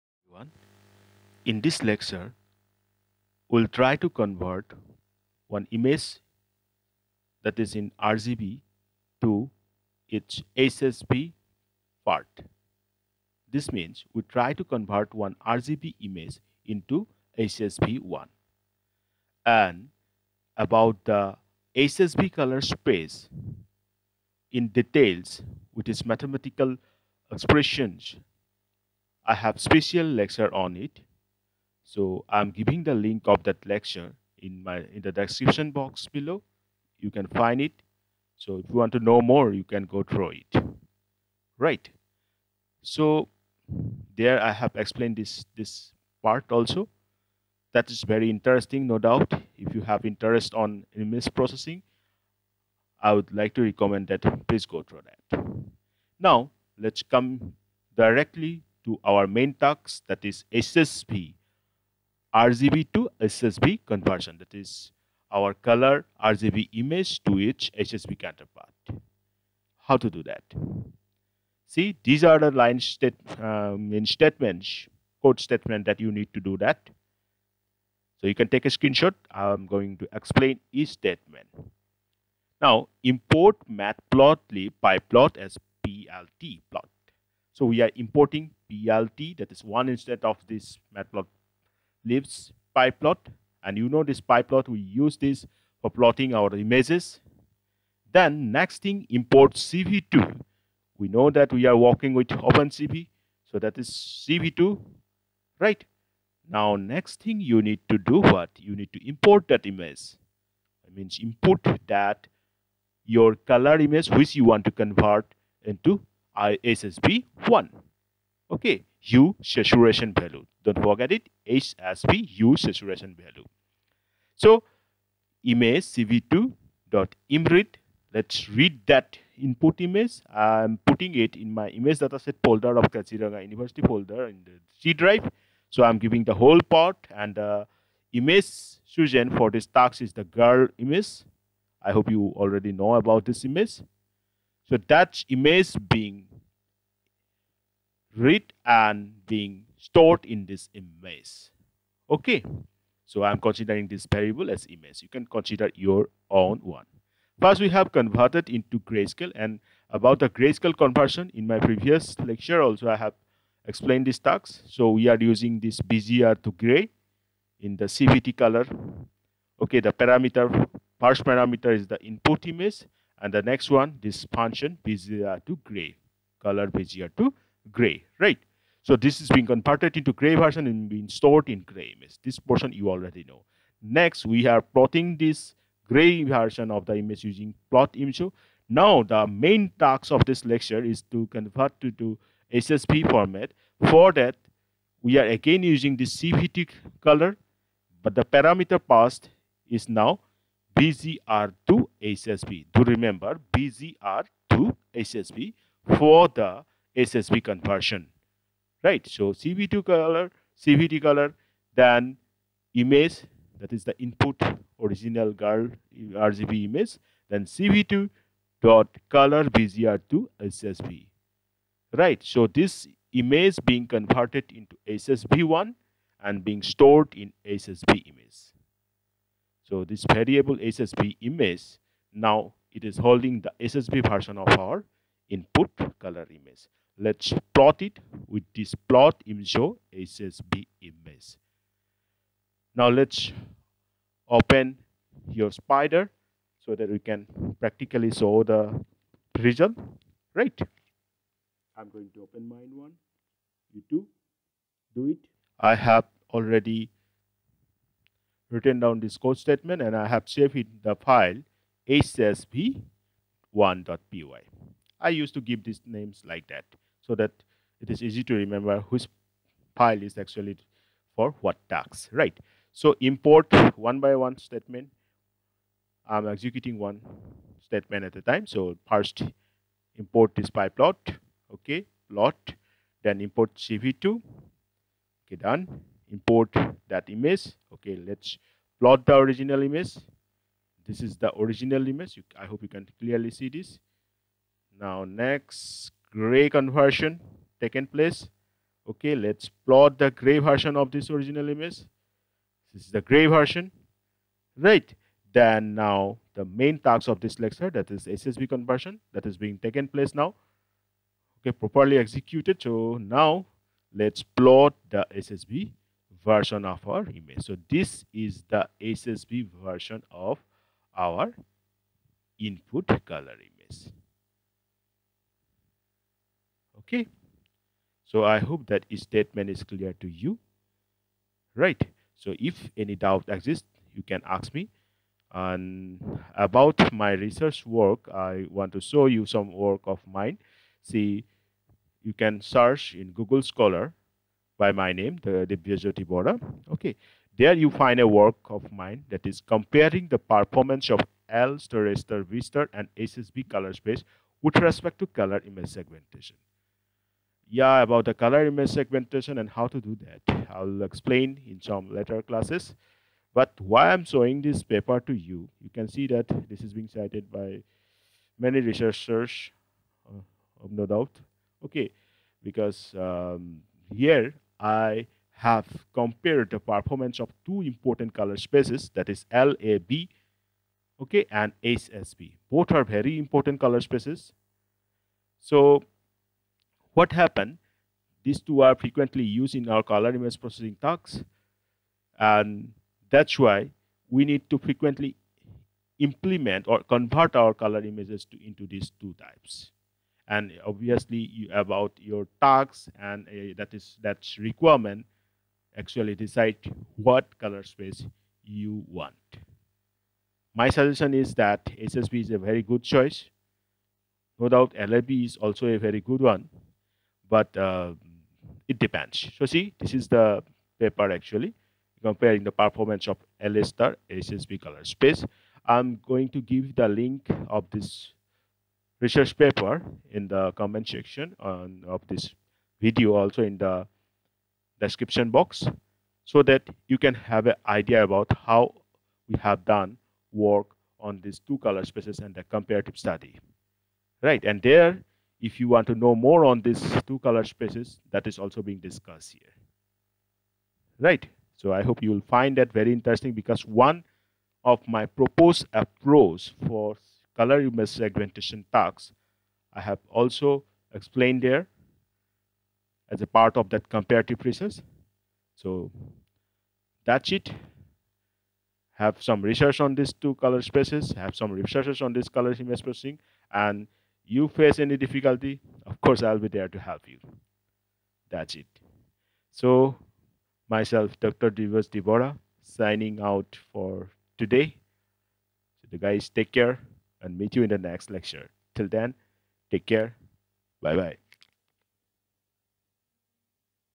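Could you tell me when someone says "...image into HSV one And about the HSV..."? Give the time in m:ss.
0:16.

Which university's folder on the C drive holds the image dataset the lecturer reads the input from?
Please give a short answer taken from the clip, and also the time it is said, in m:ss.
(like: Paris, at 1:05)
Kaziranga University, at 2:12.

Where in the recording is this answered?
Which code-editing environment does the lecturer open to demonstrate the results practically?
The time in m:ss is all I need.
4:05.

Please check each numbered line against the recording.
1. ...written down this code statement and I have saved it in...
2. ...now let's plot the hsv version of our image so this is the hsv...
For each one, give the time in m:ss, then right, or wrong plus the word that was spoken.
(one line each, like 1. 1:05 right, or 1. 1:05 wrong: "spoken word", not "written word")
1. 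4:18 right
2. 5:12 right.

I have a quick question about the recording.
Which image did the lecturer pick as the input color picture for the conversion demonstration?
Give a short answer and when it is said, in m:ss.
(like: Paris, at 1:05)
The girl image, at 2:20.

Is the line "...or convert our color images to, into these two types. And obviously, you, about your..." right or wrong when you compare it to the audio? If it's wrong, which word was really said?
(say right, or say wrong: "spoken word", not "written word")
right.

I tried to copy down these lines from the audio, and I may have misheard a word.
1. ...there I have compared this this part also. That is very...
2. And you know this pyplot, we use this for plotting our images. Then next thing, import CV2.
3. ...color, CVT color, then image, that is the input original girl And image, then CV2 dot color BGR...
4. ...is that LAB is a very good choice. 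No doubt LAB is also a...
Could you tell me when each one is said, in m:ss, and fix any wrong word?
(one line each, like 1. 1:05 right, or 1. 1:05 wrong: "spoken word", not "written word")
1. 0:44 wrong: "explained", not "compared"
2. 1:33 right
3. 3:29 wrong: "RGB", not "And"
4. 6:51 wrong: "HSV", not "LAB".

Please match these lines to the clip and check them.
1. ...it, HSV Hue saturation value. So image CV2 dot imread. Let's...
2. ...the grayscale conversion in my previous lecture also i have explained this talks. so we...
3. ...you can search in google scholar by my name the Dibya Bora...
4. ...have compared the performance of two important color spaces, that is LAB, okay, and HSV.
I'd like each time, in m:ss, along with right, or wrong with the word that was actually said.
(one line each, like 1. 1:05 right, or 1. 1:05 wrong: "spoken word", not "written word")
1. 2:01 right
2. 2:40 right
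3. 5:42 wrong: "Jyoti", not "Bora"
4. 6:15 right.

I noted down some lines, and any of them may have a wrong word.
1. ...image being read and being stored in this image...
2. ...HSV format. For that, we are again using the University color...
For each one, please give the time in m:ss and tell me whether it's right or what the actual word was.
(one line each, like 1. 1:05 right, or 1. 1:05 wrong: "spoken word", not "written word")
1. 2:25 right
2. 3:12 wrong: "CVT", not "University".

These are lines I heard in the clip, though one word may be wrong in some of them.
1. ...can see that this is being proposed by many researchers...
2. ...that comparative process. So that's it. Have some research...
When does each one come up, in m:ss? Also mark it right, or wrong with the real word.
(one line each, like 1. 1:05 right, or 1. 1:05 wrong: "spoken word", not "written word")
1. 6:05 wrong: "cited", not "proposed"
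2. 7:43 right.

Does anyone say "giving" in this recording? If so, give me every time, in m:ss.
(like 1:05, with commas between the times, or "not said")
0:32, 2:15.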